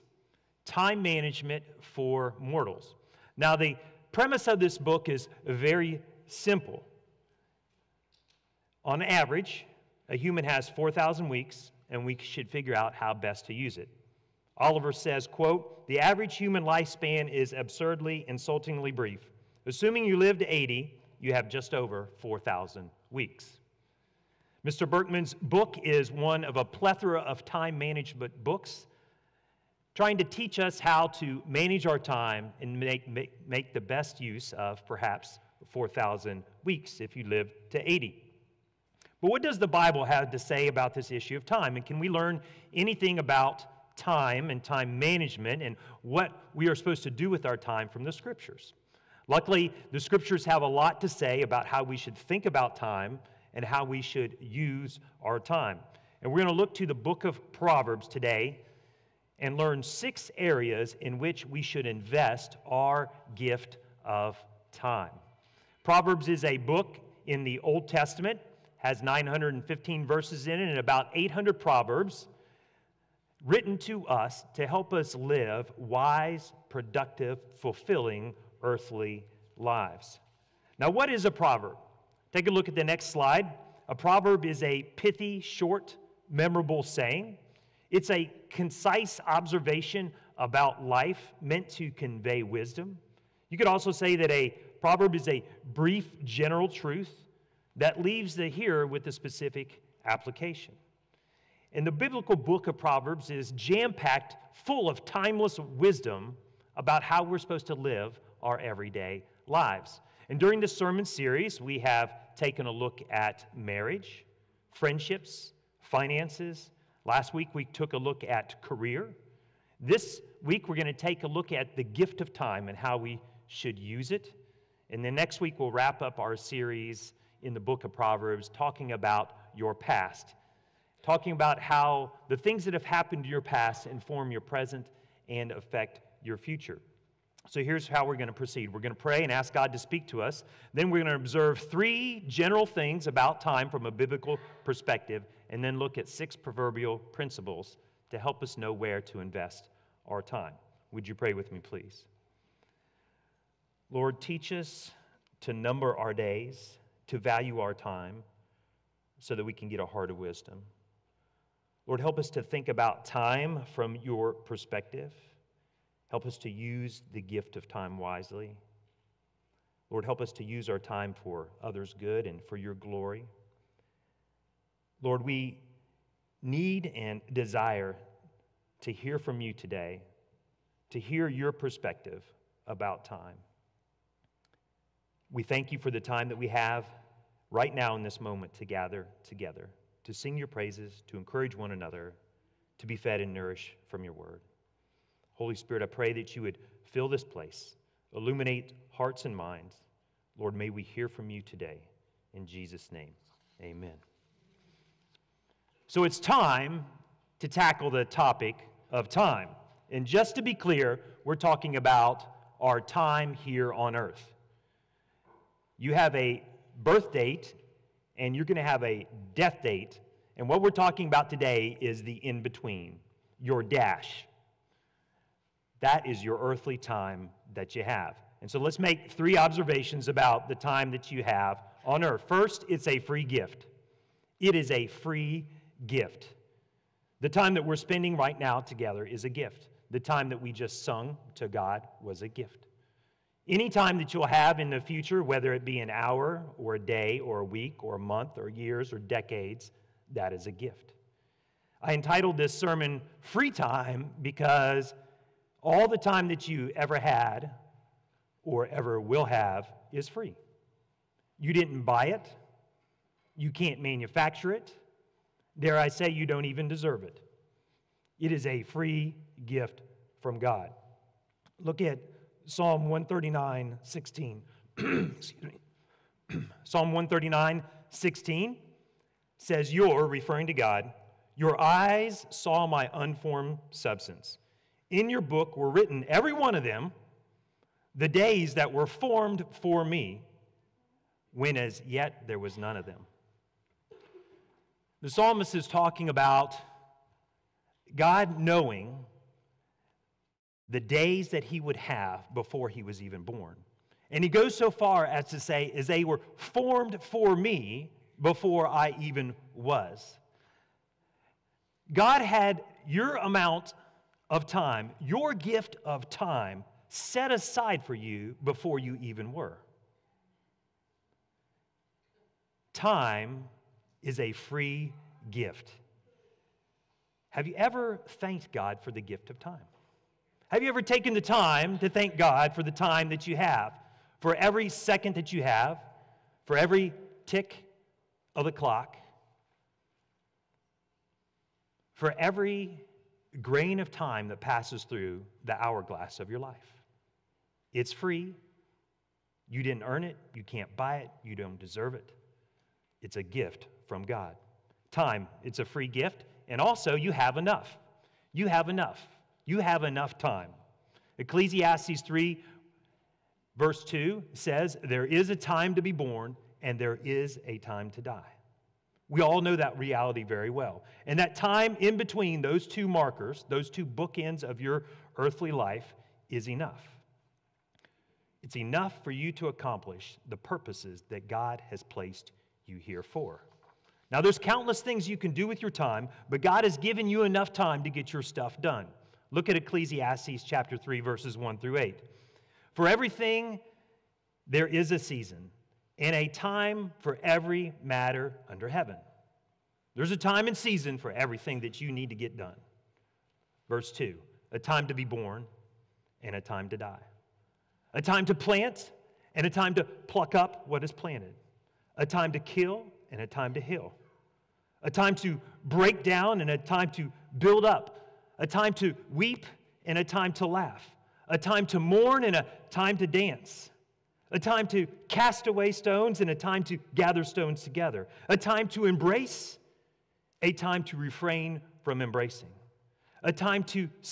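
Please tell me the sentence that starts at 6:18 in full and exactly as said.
It's enough for you to accomplish the purposes that God has placed you here for.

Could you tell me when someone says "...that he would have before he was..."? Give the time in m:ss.
5:01.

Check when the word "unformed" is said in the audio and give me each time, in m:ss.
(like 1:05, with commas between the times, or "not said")
4:42.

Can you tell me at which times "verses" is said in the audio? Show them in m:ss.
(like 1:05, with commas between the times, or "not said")
1:10, 6:03, 6:30, 6:43.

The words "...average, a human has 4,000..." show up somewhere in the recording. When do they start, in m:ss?
0:09.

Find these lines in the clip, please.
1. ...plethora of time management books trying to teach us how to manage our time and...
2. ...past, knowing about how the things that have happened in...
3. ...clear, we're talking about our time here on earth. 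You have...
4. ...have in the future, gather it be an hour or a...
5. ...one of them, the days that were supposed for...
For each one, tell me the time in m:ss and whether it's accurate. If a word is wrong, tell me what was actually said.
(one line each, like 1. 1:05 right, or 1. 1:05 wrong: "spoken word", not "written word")
1. 0:26 right
2. 2:09 wrong: "talking", not "knowing"
3. 3:30 right
4. 4:04 wrong: "whether", not "gather"
5. 4:46 wrong: "formed", not "supposed".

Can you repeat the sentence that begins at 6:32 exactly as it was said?
For everything, there is a season in a time for every matter under heaven.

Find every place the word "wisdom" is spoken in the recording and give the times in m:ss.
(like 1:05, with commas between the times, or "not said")
1:32, 1:45, 2:40.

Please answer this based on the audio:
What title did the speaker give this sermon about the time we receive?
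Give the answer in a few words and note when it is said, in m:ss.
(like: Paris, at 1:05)
Free Time, at 4:13.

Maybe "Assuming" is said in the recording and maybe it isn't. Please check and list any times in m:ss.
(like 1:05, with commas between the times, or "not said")
0:19.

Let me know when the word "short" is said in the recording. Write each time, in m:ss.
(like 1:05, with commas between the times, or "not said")
1:25.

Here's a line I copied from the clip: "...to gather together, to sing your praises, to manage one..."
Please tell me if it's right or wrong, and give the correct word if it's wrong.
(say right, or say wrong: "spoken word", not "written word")
wrong: "encourage", not "manage".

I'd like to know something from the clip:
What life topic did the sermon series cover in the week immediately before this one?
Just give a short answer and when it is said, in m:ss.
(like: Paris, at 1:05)
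Career, at 1:58.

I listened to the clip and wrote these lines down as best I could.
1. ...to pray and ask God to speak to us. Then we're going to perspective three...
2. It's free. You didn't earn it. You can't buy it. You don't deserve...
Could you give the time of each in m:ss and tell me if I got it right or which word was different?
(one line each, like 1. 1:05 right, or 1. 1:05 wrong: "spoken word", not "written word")
1. 2:18 wrong: "observe", not "perspective"
2. 5:47 right.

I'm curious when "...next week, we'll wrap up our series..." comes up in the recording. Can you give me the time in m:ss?
2:05.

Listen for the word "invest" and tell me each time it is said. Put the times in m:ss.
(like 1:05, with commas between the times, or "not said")
1:01, 2:29.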